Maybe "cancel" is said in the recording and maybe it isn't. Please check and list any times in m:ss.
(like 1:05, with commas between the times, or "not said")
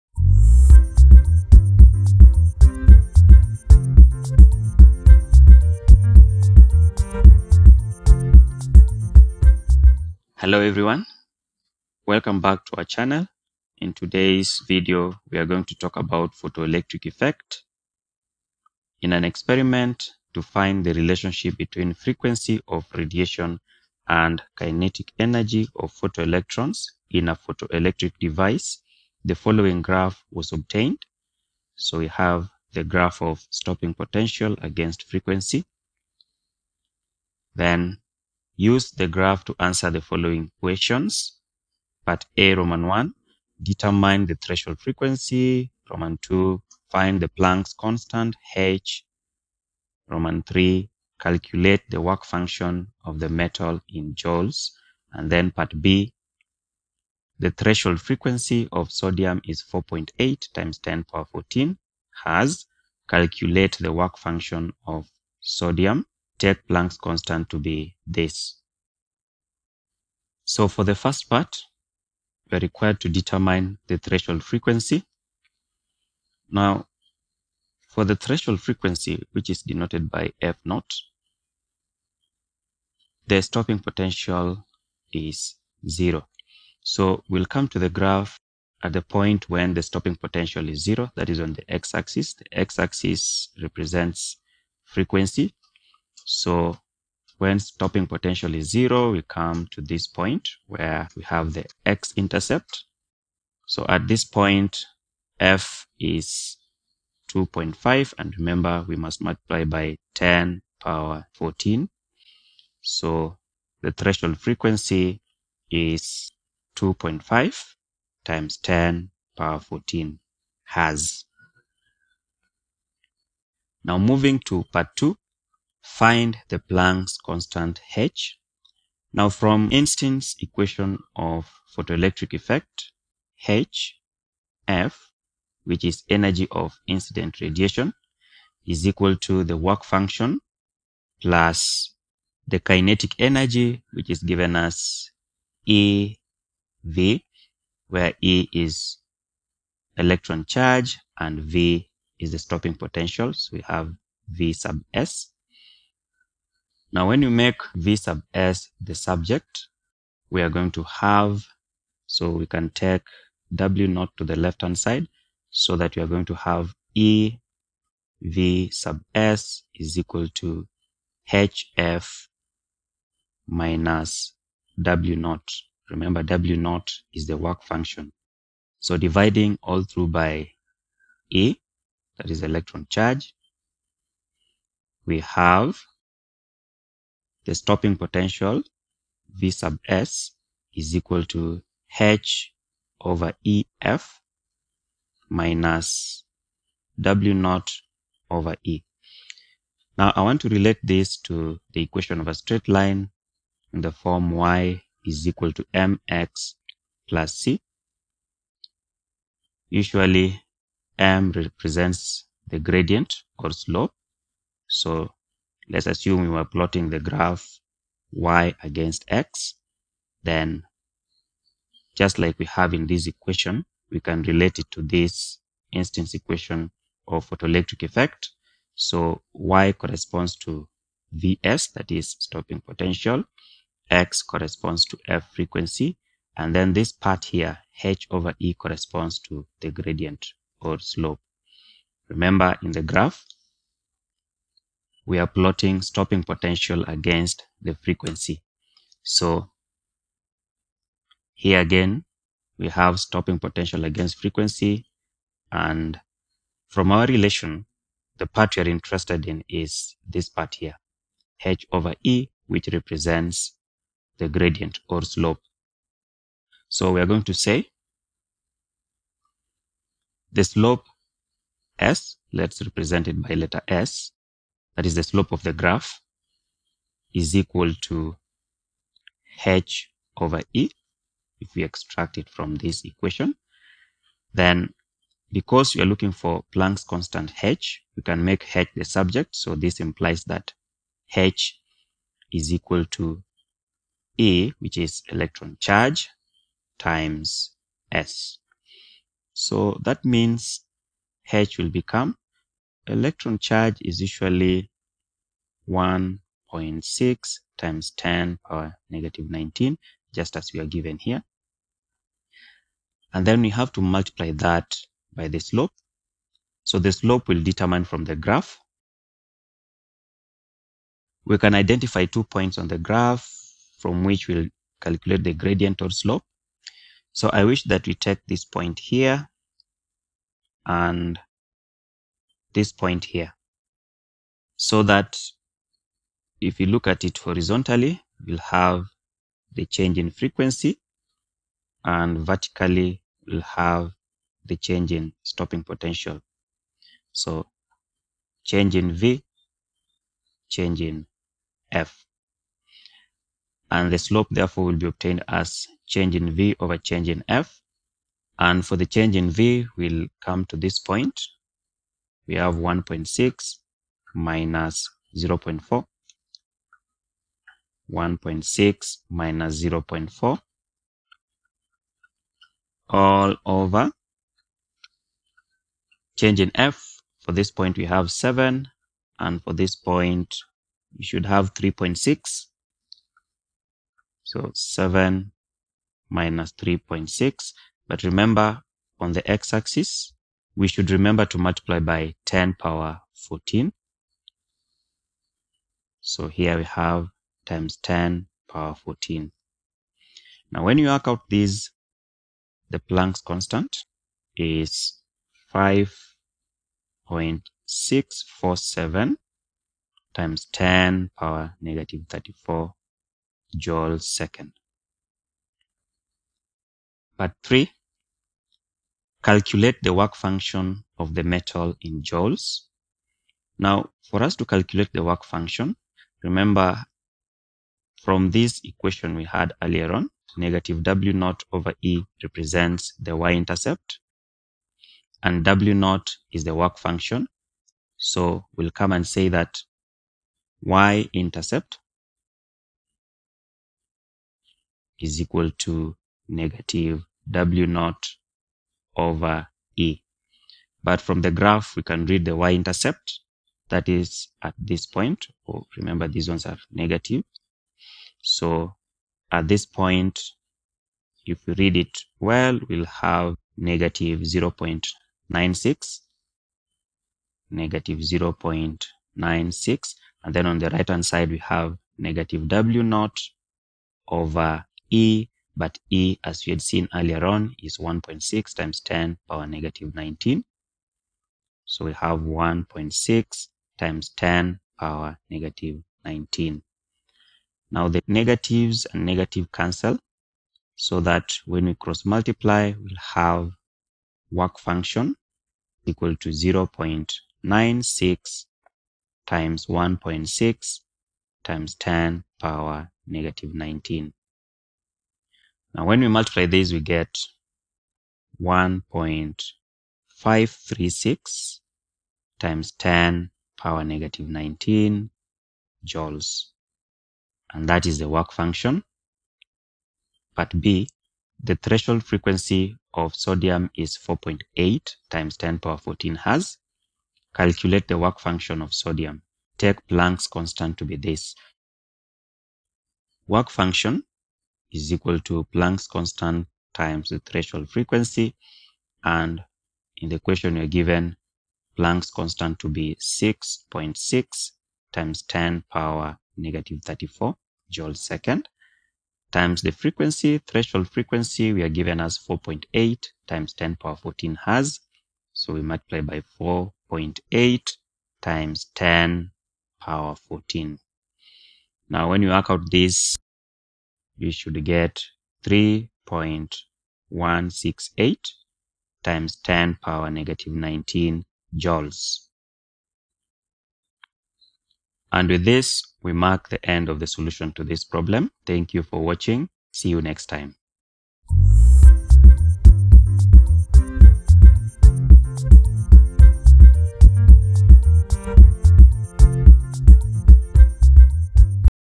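8:09.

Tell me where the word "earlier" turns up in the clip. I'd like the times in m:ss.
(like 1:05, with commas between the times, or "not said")
7:09, 7:56.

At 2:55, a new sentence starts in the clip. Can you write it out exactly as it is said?
Remember, W naught is the work function.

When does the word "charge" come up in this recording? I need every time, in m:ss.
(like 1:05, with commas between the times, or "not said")
2:30, 3:02, 4:55, 5:03.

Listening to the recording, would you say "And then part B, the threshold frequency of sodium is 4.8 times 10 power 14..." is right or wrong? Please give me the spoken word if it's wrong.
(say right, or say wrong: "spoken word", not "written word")
right.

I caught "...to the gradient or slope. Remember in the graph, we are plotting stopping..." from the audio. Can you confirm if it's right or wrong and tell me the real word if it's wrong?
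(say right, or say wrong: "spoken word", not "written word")
right.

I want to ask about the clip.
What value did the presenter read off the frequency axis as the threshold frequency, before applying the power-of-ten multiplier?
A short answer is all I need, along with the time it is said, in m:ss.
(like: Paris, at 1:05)
2.5, at 1:45.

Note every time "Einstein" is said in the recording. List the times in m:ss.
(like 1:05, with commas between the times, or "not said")
2:09, 3:45.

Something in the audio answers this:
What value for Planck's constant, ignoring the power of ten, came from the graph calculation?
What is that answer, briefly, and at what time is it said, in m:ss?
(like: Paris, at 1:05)
5.647, at 6:45.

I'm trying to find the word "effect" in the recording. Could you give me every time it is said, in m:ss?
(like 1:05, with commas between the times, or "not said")
0:17, 2:12, 3:47.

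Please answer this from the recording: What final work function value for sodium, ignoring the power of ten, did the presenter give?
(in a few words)
3.168.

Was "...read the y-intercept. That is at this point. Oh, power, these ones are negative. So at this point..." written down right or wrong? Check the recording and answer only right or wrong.
wrong.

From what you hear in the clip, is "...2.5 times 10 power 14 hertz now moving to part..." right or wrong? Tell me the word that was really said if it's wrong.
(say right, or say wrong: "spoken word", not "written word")
right.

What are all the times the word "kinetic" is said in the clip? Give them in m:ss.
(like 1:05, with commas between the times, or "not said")
0:24, 2:22.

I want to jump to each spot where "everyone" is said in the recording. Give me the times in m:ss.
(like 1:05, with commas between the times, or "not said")
0:10.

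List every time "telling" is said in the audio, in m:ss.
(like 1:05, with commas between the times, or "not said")
not said.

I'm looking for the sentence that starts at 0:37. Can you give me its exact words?
Then Use the graph to answer the following questions.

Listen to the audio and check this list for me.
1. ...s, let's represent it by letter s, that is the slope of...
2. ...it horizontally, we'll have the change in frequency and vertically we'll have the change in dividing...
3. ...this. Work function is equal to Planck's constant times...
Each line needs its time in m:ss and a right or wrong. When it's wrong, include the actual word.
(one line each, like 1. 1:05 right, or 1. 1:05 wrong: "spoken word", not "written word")
1. 4:31 right
2. 5:37 wrong: "stopping", not "dividing"
3. 8:50 right.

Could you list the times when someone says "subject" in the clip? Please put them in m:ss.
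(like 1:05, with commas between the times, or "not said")
2:38, 4:48.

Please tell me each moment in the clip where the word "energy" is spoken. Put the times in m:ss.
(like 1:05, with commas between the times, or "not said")
0:25, 2:16, 2:23.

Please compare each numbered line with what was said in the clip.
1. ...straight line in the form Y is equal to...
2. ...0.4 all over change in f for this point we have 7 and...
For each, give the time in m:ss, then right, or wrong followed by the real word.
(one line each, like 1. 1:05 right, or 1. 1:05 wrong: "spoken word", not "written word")
1. 3:22 right
2. 6:09 right.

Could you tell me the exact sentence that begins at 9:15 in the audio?
So we multiply by 4.8 times 10 power 14.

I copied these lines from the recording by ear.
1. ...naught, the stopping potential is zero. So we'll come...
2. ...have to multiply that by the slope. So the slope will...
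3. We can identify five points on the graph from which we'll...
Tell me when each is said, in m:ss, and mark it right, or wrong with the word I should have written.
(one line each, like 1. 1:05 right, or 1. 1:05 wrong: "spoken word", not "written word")
1. 1:20 right
2. 5:13 right
3. 5:21 wrong: "two", not "five".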